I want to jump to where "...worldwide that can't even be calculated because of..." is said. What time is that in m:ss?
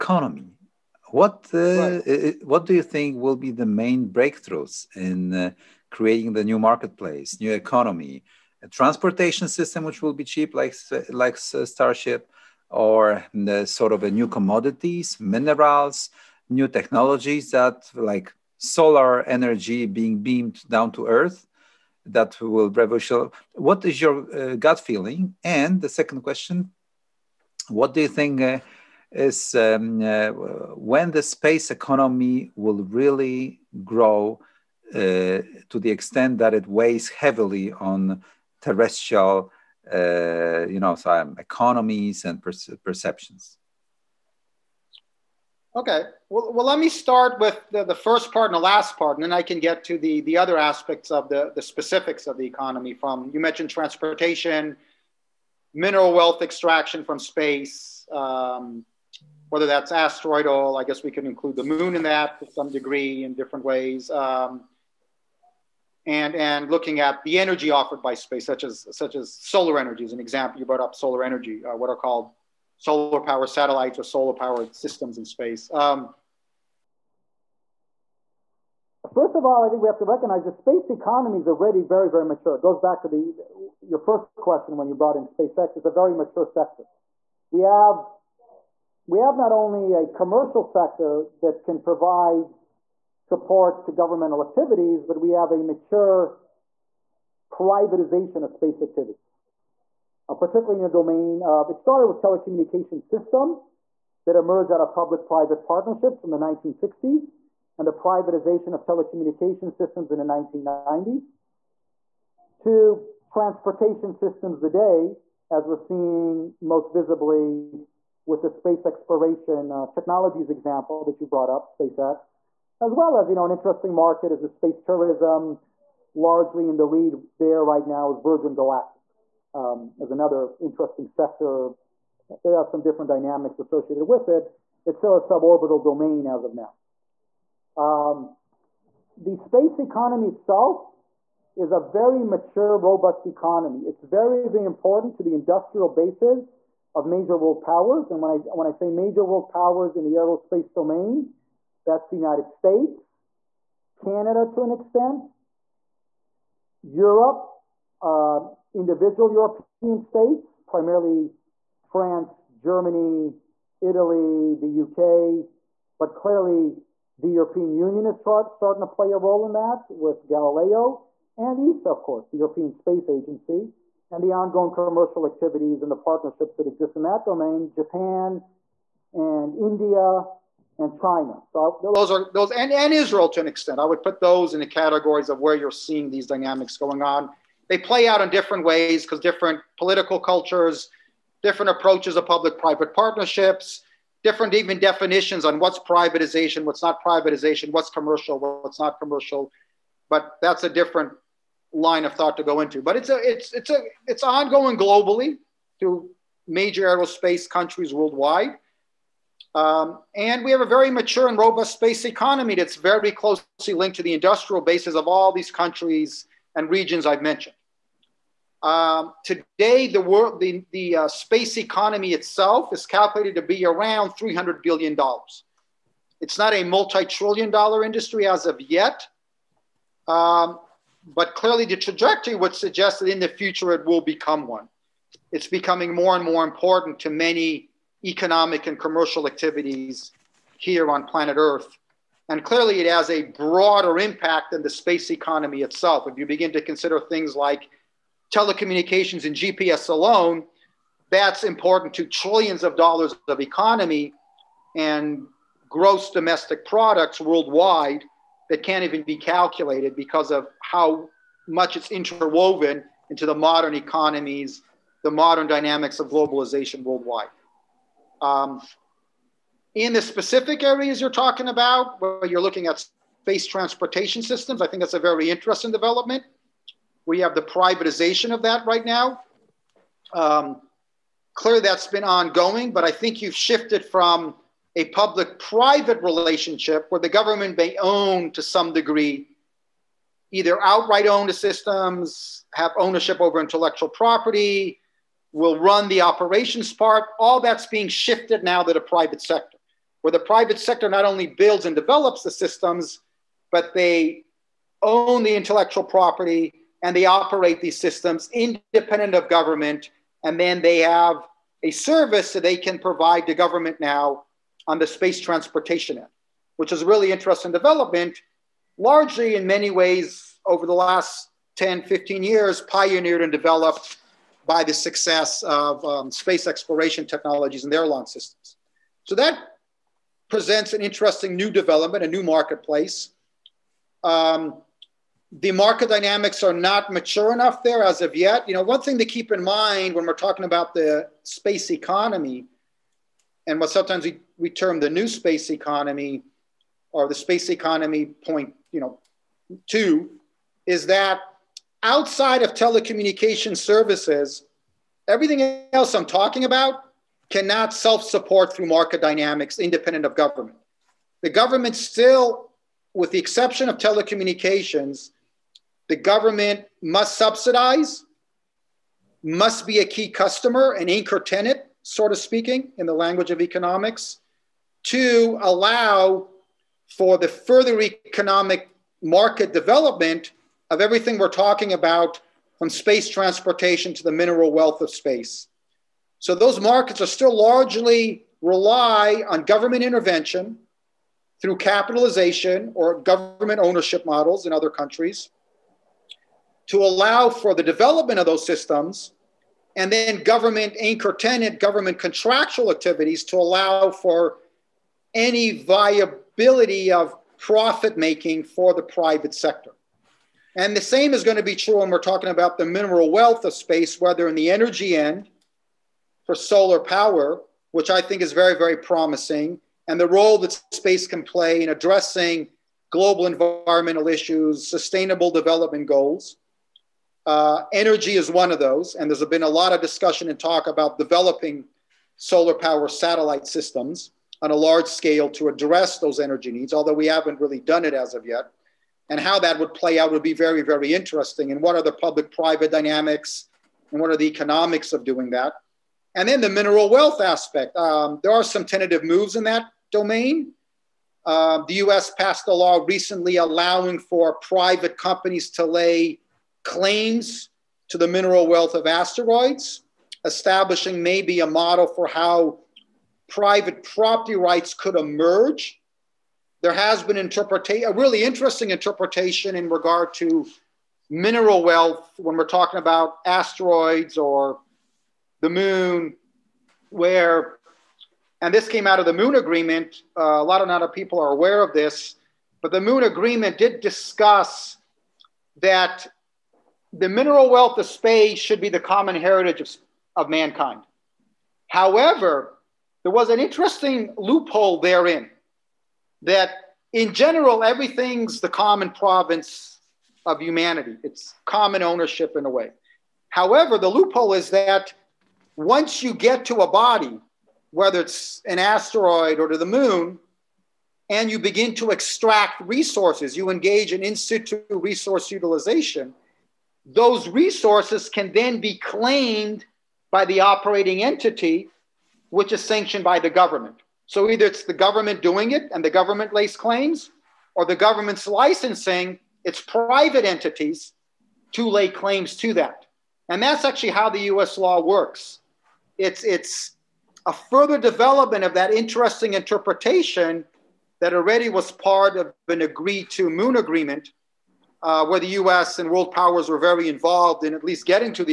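4:17.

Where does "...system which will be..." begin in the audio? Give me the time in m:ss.
0:09.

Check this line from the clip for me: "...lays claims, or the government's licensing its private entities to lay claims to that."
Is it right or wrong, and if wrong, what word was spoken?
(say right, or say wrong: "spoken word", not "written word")
right.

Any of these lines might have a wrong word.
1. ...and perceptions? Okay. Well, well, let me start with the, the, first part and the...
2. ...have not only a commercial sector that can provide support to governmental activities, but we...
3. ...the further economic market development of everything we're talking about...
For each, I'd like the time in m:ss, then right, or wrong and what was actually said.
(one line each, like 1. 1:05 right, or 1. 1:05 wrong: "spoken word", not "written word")
1. 0:42 right
2. 1:29 right
3. 6:17 right.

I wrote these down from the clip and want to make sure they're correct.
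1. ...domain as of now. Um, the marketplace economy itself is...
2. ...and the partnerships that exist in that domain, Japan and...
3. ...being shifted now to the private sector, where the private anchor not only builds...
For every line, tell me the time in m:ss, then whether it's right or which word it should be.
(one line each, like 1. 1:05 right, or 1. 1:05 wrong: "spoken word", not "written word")
1. 2:15 wrong: "space", not "marketplace"
2. 2:55 right
3. 4:57 wrong: "sector", not "anchor".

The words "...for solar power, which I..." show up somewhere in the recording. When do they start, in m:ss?
6:56.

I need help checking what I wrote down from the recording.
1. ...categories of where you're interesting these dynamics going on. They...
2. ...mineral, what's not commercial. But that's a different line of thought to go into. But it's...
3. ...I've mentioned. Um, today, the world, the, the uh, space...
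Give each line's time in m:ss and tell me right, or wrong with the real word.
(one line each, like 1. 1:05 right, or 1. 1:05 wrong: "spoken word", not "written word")
1. 3:04 wrong: "seeing", not "interesting"
2. 3:17 wrong: "commercial", not "mineral"
3. 3:37 right.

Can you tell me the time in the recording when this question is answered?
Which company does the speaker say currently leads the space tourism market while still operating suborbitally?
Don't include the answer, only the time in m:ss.
2:08.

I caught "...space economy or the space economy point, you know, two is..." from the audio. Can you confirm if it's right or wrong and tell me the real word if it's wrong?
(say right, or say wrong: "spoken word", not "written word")
right.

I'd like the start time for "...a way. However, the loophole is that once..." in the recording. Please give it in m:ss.
8:22.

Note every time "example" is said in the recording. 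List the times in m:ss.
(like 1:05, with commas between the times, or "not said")
1:10, 2:00.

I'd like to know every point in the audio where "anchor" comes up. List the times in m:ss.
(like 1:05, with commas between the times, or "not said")
6:10, 6:40.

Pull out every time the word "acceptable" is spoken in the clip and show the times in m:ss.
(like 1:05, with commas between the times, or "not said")
not said.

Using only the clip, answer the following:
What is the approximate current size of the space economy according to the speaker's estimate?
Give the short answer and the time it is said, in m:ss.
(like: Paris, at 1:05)
$300 billion, at 3:44.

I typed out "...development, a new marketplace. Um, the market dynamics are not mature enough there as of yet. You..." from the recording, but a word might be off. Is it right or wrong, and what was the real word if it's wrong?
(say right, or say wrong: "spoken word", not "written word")
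right.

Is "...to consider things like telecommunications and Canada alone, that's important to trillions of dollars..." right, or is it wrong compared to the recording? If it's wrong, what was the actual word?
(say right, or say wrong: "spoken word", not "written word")
wrong: "GPS", not "Canada".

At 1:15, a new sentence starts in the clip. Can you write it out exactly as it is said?
Um, first of all, I think we have to recognize the space economy is already very, very mature.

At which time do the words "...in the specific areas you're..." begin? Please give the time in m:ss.
4:29.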